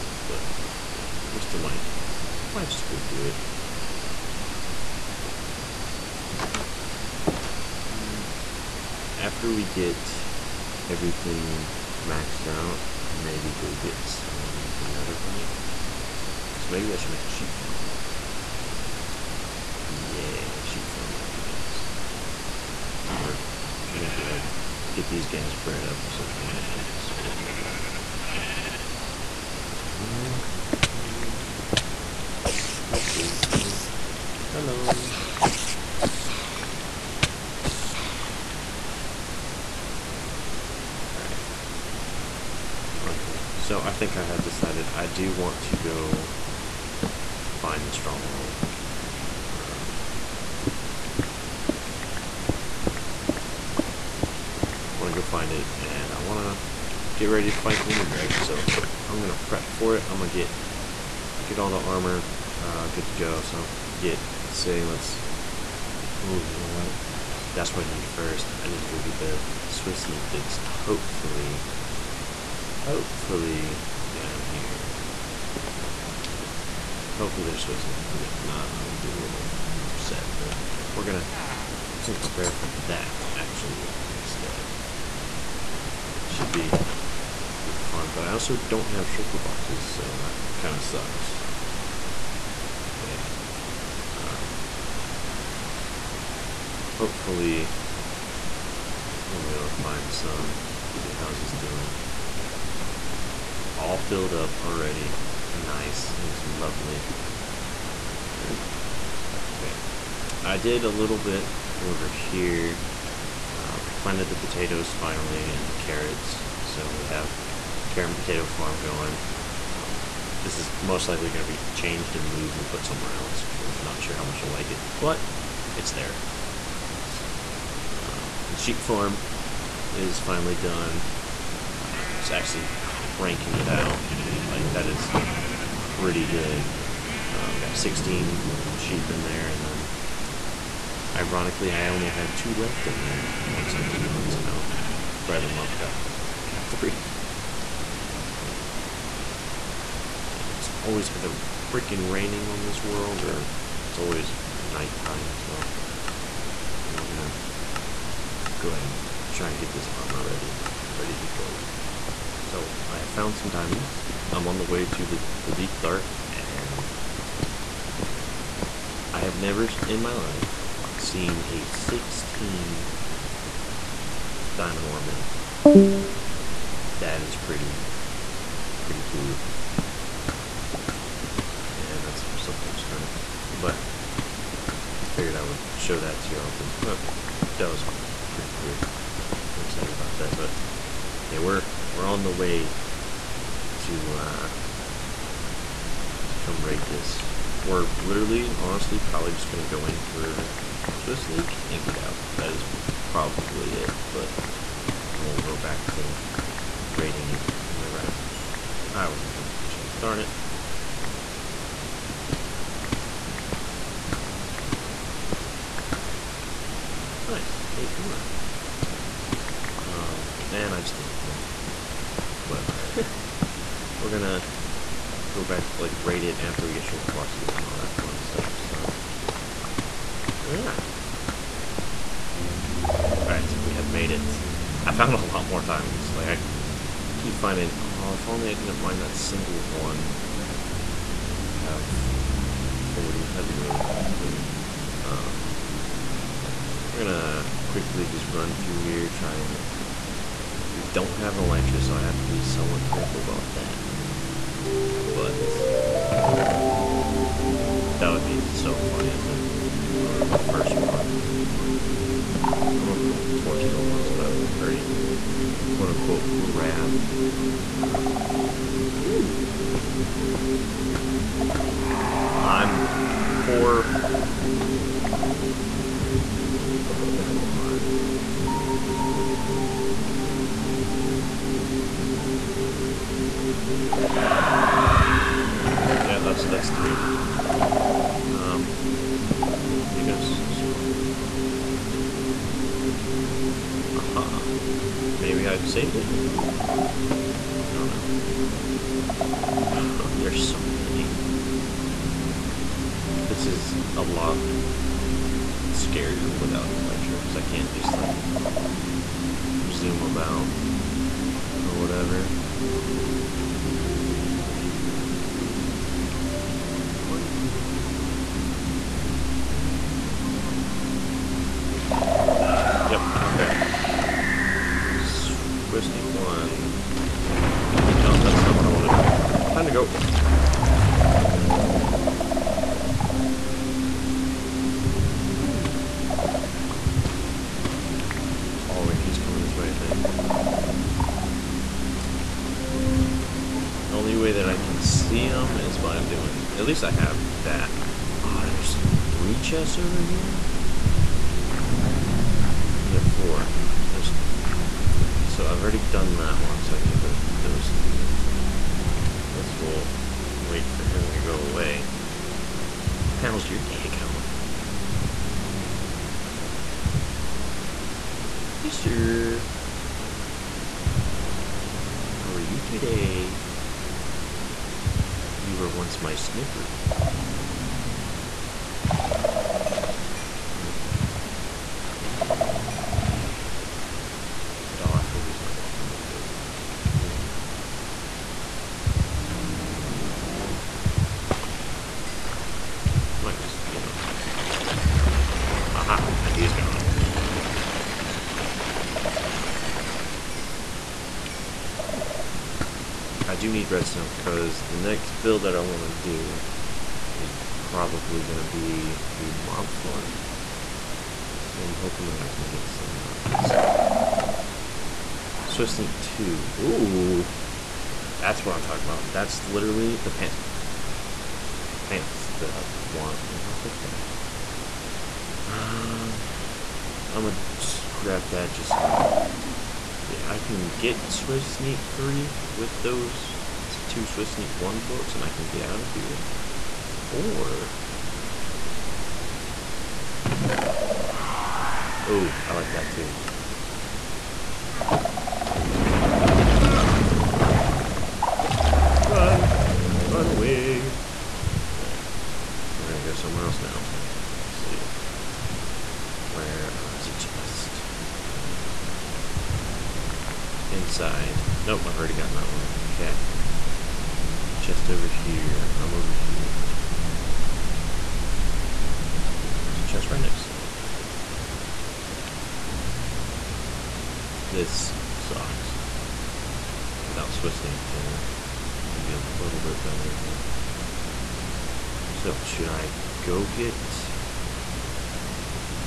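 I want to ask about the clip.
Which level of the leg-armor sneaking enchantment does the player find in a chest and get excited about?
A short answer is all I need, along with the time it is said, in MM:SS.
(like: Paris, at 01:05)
Swift Sneak 2, at 06:55.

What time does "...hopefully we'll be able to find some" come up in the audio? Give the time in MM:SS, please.
01:36.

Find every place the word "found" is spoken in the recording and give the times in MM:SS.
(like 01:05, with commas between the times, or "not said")
02:43, 03:54.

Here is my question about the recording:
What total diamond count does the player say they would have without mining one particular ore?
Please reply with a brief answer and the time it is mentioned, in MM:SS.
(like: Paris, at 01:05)
40, at 04:03.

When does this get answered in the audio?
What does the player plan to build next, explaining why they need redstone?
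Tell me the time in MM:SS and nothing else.
06:49.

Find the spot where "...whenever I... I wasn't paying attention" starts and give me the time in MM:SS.
03:27.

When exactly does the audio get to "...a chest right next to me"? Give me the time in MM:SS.
07:49.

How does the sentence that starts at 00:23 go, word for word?
We're, we're gonna go ahead and get these guys bred up some more and then start working on that.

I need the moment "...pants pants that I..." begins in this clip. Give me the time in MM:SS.
07:00.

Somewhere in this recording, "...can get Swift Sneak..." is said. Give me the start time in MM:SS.
07:10.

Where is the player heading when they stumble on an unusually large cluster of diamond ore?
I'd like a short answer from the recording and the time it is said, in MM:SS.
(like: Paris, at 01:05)
the deep dark, at 02:45.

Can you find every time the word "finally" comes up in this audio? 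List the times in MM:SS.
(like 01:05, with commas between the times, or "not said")
01:54, 02:10.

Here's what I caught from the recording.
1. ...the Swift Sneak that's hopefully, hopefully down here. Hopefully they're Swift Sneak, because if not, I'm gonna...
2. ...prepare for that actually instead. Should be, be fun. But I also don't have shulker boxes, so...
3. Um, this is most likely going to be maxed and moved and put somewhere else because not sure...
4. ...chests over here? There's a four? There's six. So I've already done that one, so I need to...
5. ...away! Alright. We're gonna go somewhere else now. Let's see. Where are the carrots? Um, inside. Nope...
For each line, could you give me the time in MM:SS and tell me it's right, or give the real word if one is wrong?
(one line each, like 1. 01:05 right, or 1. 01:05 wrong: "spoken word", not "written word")
1. 01:09 right
2. 01:22 right
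3. 01:59 wrong: "changed", not "maxed"
4. 05:49 wrong: "three", not "six"
5. 07:30 wrong: "chests", not "carrots".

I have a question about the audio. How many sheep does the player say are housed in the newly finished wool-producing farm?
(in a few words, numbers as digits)
16.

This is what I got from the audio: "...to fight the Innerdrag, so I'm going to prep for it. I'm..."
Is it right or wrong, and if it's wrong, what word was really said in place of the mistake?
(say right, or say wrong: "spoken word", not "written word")
right.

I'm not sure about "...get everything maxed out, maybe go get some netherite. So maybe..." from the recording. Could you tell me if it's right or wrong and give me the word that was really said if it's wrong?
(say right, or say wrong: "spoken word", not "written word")
right.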